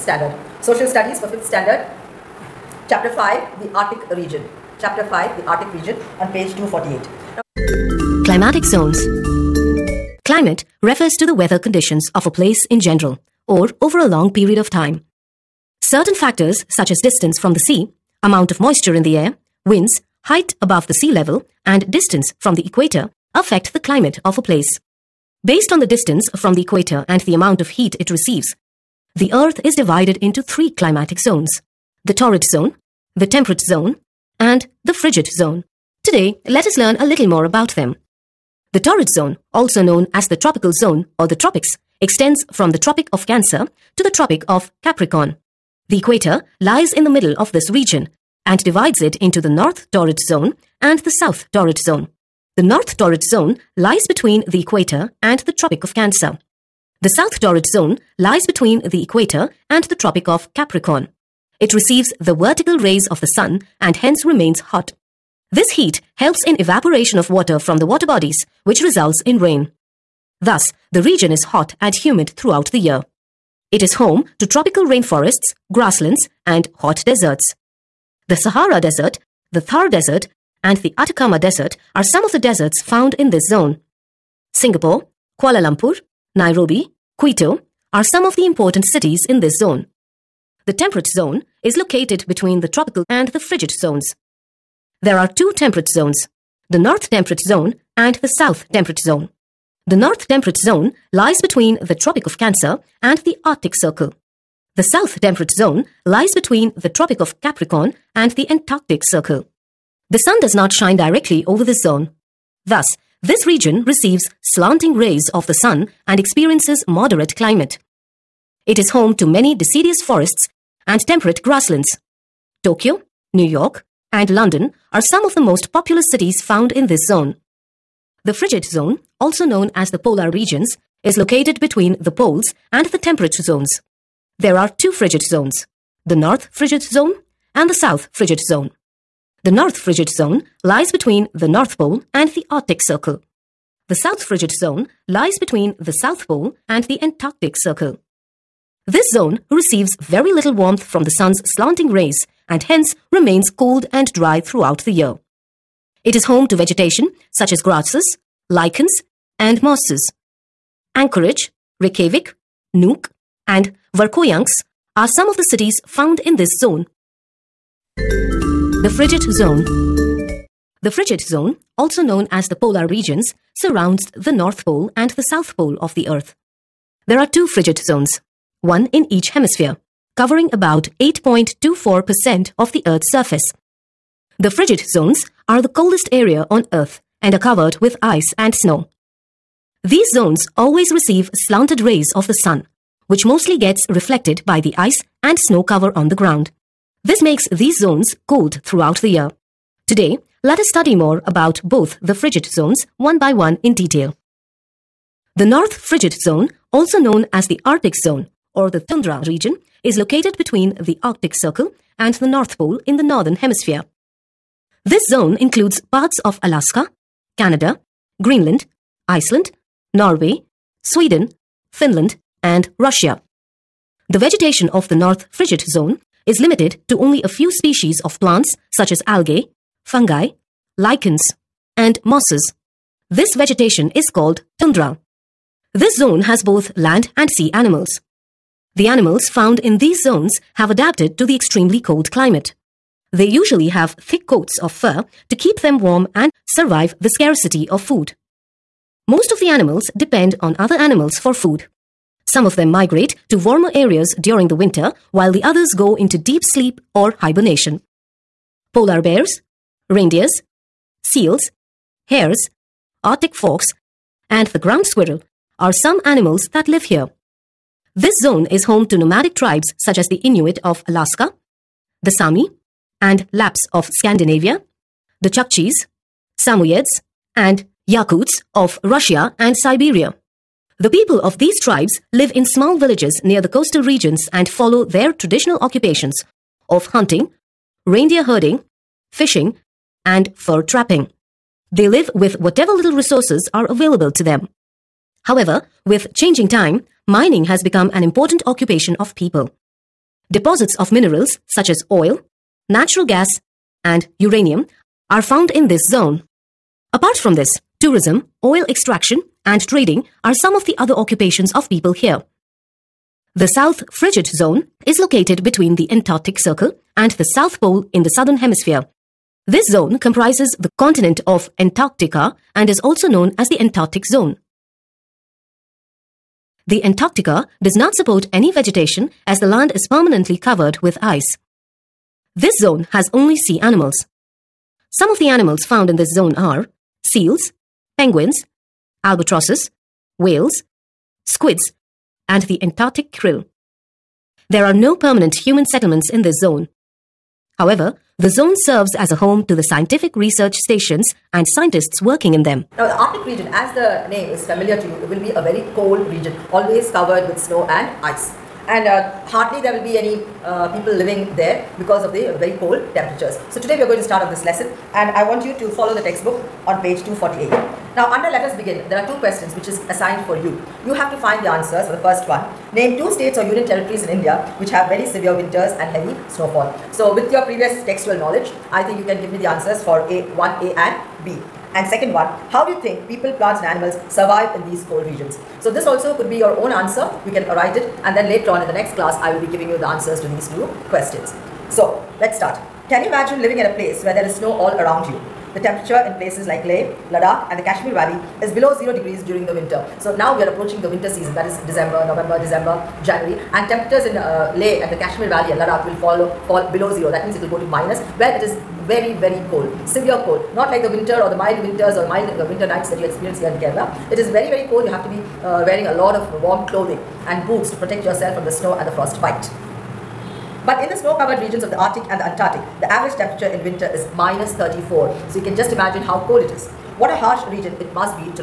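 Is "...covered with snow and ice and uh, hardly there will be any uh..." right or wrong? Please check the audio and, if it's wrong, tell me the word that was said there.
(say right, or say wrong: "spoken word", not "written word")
right.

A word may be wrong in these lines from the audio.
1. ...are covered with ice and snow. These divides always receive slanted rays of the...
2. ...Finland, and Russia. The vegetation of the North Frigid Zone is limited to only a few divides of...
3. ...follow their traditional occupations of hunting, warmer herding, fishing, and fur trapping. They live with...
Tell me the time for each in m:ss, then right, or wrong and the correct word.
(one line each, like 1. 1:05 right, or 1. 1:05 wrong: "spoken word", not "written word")
1. 3:07 wrong: "zones", not "divides"
2. 3:41 wrong: "species", not "divides"
3. 4:44 wrong: "reindeer", not "warmer".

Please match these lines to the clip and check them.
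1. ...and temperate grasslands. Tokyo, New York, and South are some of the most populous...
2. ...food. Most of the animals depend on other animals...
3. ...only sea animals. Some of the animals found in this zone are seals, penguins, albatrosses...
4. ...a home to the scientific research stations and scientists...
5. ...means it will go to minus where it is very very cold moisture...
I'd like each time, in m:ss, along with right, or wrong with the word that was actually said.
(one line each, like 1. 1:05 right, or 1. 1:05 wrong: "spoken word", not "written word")
1. 2:00 wrong: "London", not "South"
2. 4:07 right
3. 5:33 right
4. 5:49 right
5. 6:47 wrong: "severe", not "moisture".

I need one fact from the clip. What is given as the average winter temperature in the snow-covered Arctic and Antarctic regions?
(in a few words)
-34.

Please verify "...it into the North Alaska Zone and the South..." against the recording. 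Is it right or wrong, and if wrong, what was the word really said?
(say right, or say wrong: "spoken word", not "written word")
wrong: "Torrid", not "Alaska".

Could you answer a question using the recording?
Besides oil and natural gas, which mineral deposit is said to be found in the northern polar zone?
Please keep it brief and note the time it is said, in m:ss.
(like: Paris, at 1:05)
uranium, at 5:04.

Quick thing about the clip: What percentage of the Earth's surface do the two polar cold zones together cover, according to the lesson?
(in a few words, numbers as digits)
8.24%.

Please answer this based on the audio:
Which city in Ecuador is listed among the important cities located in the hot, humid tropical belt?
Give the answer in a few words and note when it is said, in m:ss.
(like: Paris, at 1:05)
Quito, at 1:27.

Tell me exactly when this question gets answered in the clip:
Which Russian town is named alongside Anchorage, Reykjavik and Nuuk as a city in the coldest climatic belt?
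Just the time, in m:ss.
2:43.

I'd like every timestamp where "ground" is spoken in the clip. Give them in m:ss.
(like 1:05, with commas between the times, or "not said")
3:16, 4:24.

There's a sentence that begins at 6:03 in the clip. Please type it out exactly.
So today we are going to start on this lesson and I want you to follow the textbook on page 248.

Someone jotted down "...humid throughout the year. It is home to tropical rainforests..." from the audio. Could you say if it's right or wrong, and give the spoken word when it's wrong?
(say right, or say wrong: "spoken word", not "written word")
right.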